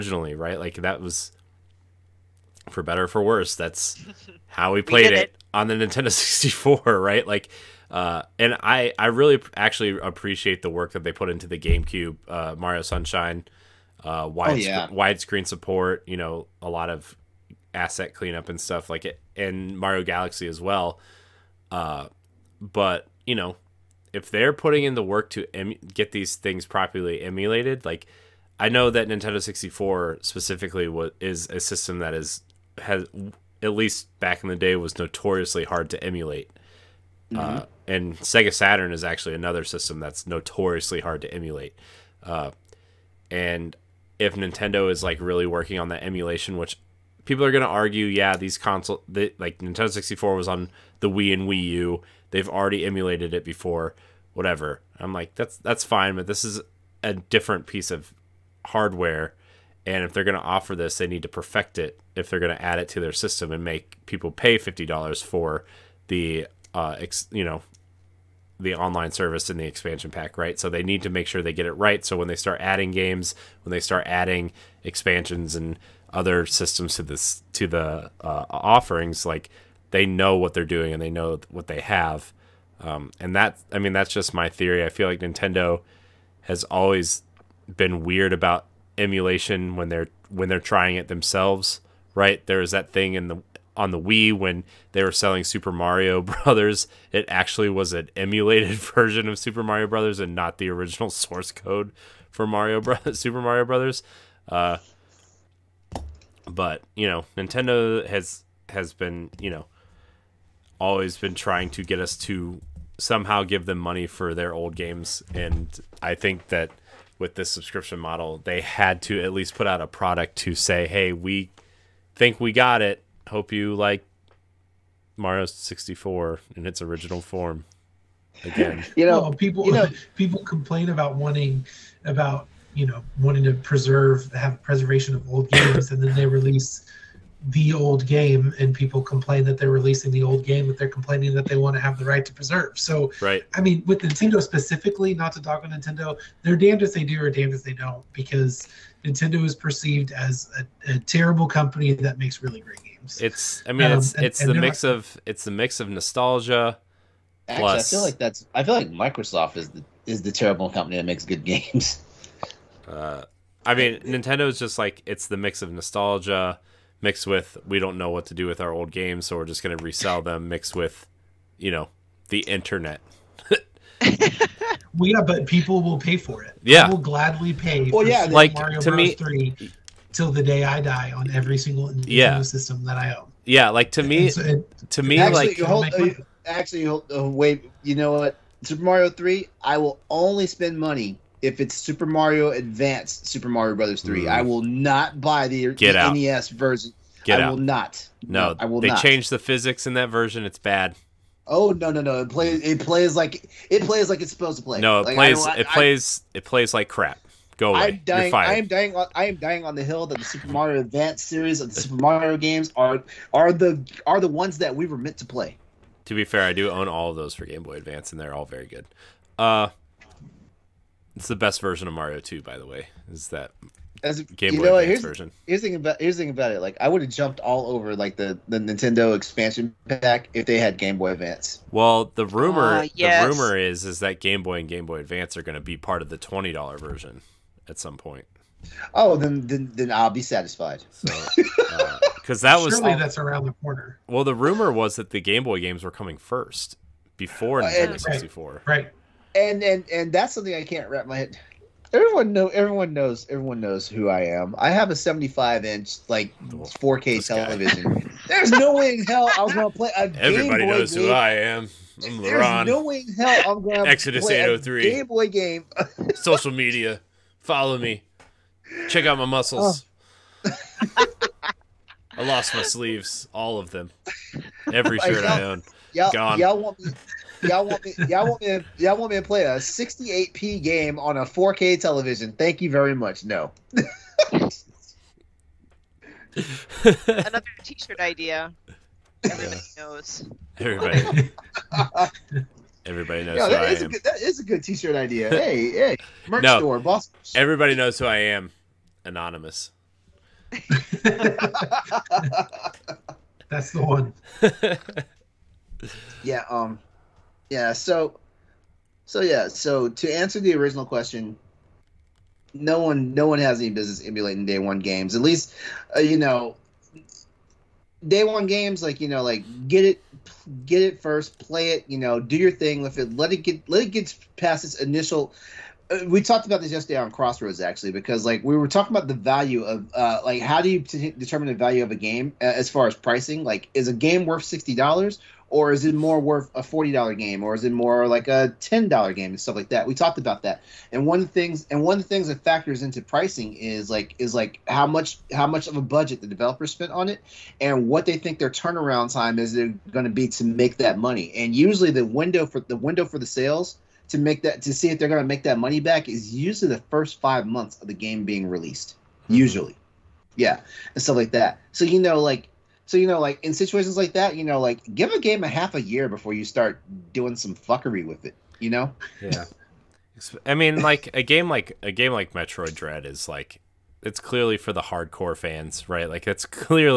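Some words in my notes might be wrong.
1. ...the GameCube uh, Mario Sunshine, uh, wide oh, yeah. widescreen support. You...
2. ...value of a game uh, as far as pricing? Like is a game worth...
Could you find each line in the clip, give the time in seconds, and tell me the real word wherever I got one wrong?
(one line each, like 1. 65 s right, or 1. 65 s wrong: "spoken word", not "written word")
1. 11 s right
2. 331 s right.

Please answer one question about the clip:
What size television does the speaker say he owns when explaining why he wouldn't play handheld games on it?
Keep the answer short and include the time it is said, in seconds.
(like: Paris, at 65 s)
75 inch, at 254 s.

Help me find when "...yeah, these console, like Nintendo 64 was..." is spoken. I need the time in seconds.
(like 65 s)
48 s.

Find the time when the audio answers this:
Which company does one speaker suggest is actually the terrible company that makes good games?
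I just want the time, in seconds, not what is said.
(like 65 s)
158 s.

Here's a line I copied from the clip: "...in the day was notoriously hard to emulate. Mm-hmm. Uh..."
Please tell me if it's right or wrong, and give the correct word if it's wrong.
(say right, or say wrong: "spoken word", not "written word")
right.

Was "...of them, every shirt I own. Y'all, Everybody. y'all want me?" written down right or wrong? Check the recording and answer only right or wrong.
wrong.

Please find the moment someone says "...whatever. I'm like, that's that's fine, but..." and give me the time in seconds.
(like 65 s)
54 s.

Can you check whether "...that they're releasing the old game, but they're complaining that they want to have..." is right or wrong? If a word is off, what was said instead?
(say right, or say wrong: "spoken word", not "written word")
right.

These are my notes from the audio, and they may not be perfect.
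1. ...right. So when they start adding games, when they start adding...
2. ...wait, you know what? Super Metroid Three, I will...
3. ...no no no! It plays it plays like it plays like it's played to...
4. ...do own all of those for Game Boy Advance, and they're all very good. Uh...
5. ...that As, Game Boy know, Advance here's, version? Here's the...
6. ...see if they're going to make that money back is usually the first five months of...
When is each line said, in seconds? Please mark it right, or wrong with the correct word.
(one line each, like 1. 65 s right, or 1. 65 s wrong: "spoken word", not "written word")
1. 71 s right
2. 187 s wrong: "Mario", not "Metroid"
3. 201 s wrong: "supposed", not "played"
4. 216 s right
5. 223 s right
6. 354 s right.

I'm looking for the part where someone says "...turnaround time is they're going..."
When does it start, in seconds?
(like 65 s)
348 s.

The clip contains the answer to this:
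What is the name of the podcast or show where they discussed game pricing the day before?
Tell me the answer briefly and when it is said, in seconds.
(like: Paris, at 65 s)
Crossroads, at 327 s.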